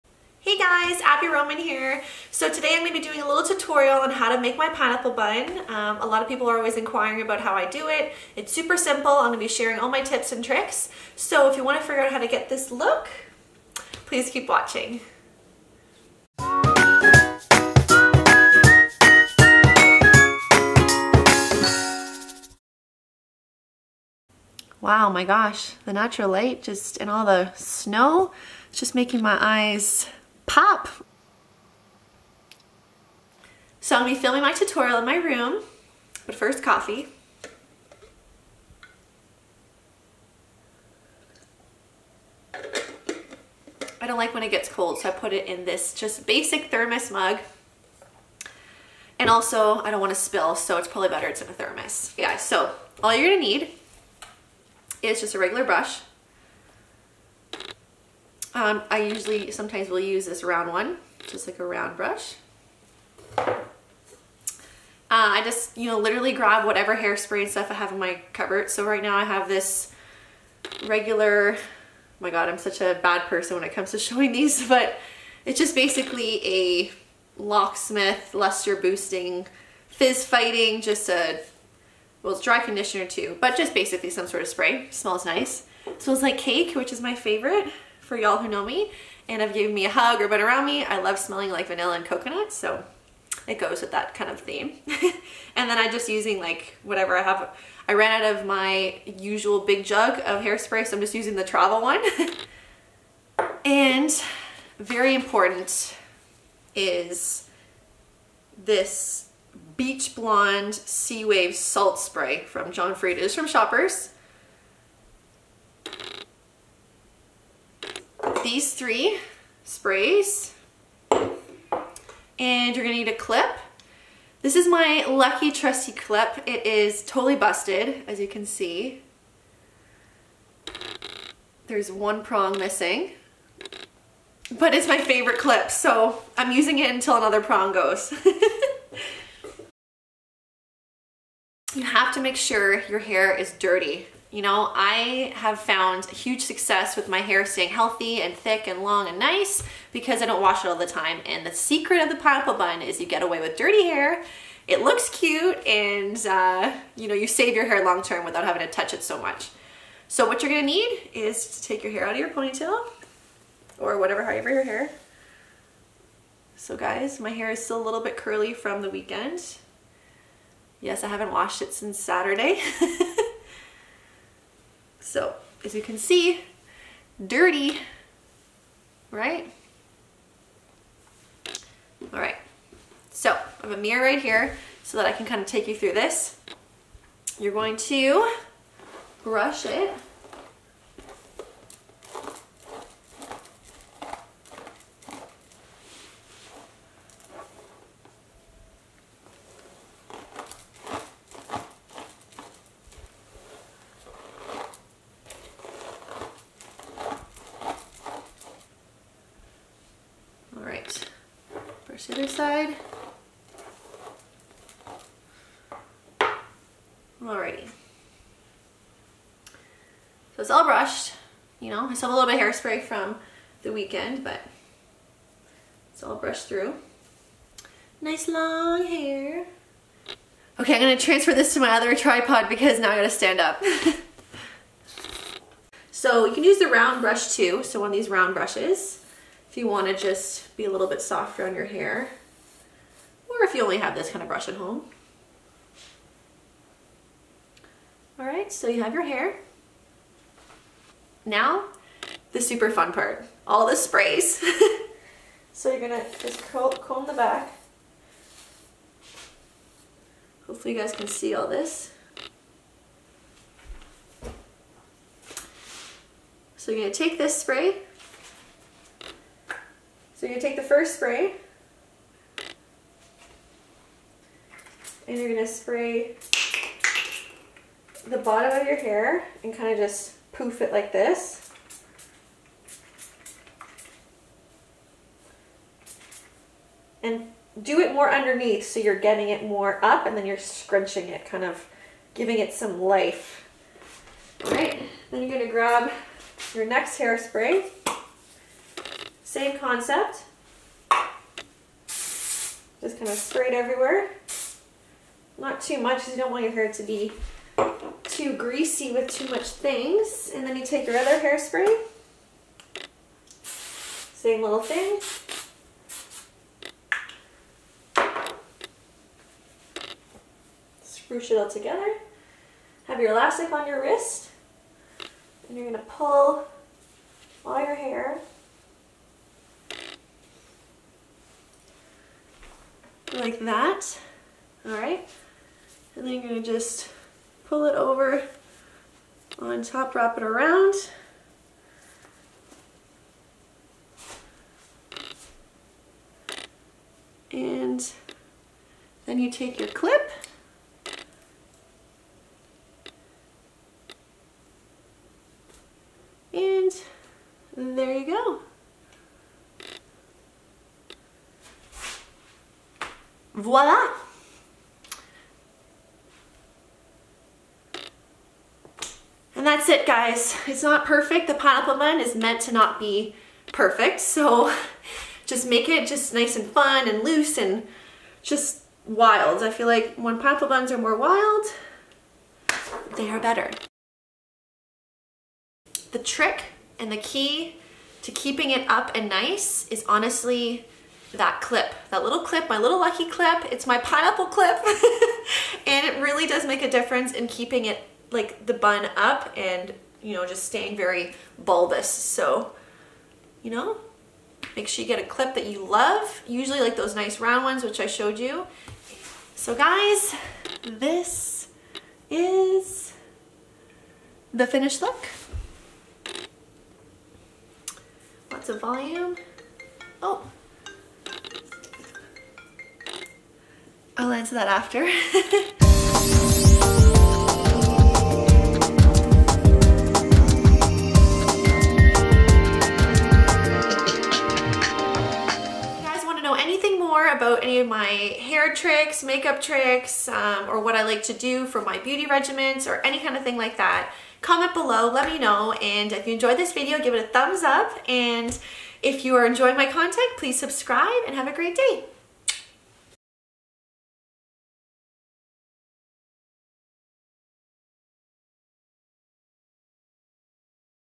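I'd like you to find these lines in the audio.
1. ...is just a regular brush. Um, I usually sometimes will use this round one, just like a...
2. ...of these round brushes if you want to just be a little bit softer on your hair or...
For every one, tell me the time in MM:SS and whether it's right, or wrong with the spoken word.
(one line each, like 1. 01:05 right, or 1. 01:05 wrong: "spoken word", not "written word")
1. 00:55 right
2. 03:57 right.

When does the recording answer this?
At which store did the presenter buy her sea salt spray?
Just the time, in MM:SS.
01:53.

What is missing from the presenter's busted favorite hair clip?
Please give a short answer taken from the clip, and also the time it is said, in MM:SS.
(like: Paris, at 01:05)
One prong, at 02:11.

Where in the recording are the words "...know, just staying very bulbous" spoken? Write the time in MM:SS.
06:40.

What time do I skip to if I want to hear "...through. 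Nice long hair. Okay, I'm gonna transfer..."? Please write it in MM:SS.
03:46.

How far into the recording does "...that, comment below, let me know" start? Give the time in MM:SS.
07:23.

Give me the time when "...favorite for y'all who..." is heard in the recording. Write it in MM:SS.
01:27.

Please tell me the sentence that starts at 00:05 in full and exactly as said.
Um, a lot of people are always inquiring about how I do it.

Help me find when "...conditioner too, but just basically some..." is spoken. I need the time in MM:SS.
01:22.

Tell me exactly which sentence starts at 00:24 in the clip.
Wow, my gosh, the natural light just and all the snow, it's just making my eyes pop.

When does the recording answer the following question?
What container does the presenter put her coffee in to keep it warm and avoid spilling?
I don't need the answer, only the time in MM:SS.
00:46.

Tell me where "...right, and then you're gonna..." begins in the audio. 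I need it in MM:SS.
05:34.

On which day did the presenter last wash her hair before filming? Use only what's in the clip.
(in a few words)
Saturday.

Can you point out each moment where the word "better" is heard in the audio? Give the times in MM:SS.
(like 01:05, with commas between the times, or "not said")
00:51, 06:23.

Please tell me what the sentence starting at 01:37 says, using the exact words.
I ran out of my usual big jug of hairspray, so I'm just using the travel one.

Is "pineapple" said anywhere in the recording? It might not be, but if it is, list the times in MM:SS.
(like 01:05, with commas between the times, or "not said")
00:04, 02:32, 06:11, 06:20, 06:33.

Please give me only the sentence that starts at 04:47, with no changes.
And do it more underneath so you're getting it more up and then you're scrunching it, kind of giving it some life.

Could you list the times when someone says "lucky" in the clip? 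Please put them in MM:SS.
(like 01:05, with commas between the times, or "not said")
02:05, 06:32.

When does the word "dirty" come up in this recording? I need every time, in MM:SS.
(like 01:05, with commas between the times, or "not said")
02:23, 02:33, 02:57.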